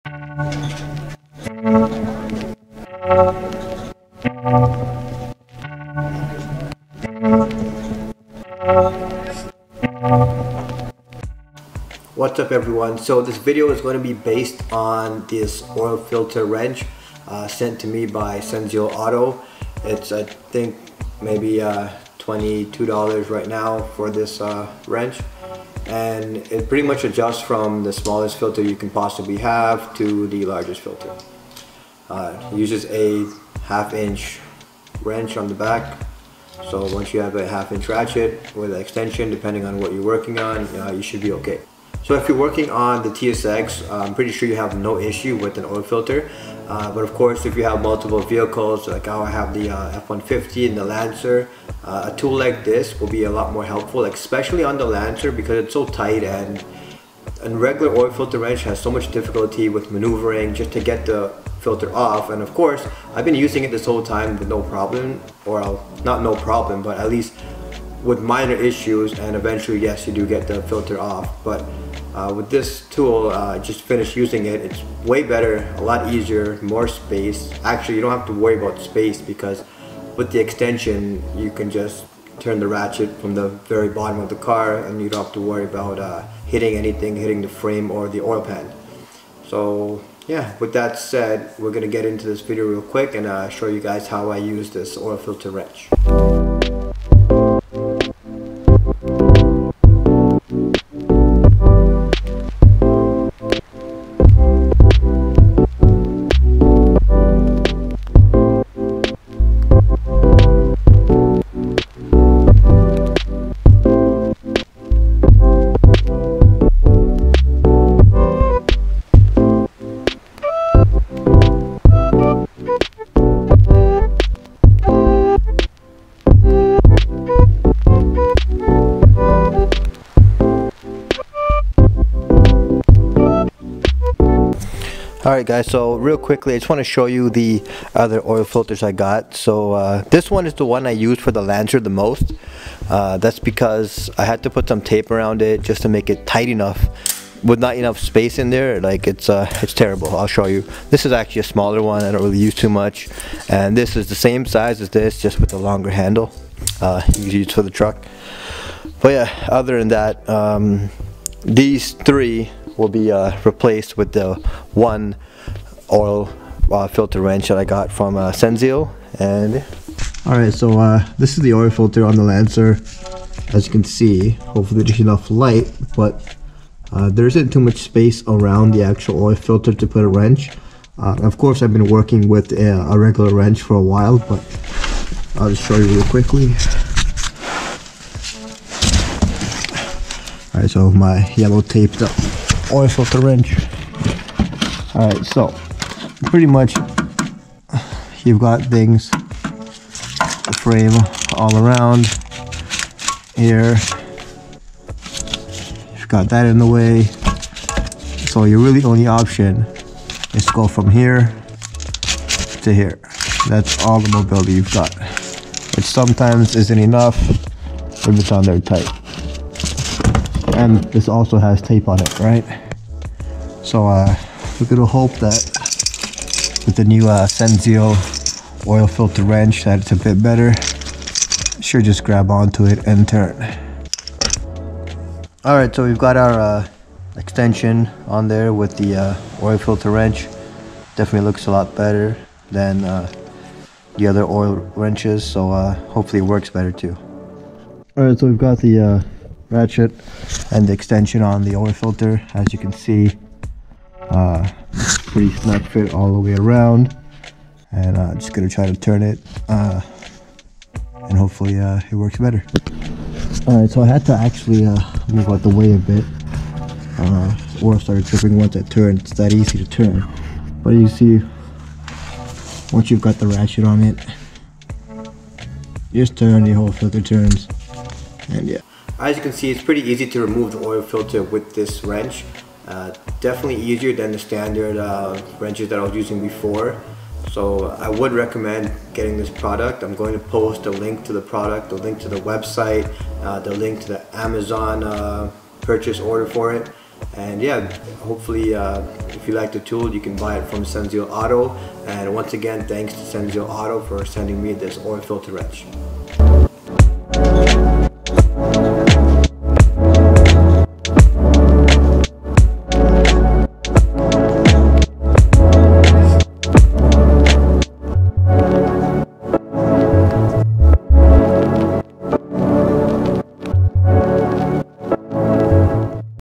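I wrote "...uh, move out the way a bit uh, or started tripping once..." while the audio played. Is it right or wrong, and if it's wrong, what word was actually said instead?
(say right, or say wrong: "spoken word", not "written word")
right.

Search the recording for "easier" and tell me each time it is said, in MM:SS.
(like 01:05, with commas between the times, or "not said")
01:16, 04:43.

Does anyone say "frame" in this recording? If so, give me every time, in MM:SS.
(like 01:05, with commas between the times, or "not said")
01:27, 03:20.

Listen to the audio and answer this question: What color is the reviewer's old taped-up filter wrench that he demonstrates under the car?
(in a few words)
yellow.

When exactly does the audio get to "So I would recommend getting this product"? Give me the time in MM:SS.
04:47.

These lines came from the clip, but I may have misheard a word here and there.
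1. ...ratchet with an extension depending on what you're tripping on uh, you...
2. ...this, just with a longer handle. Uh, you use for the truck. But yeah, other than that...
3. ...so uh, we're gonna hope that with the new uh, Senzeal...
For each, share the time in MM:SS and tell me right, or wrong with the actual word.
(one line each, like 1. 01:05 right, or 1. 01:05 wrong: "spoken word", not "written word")
1. 00:37 wrong: "working", not "tripping"
2. 02:34 right
3. 03:43 right.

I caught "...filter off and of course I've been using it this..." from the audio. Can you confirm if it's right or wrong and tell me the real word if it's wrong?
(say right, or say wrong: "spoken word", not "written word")
right.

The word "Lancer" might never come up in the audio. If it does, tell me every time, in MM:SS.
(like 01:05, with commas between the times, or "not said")
00:50, 00:54, 02:21, 02:52.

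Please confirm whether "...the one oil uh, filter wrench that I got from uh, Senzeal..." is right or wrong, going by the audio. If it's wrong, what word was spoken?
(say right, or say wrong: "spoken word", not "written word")
right.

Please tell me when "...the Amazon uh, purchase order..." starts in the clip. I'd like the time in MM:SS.
04:53.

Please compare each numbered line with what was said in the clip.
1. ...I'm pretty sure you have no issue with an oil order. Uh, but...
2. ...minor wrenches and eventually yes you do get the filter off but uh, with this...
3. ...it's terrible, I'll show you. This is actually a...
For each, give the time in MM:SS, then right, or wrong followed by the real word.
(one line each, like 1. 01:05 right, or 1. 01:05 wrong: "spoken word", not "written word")
1. 00:44 wrong: "filter", not "order"
2. 01:08 wrong: "issues", not "wrenches"
3. 02:29 right.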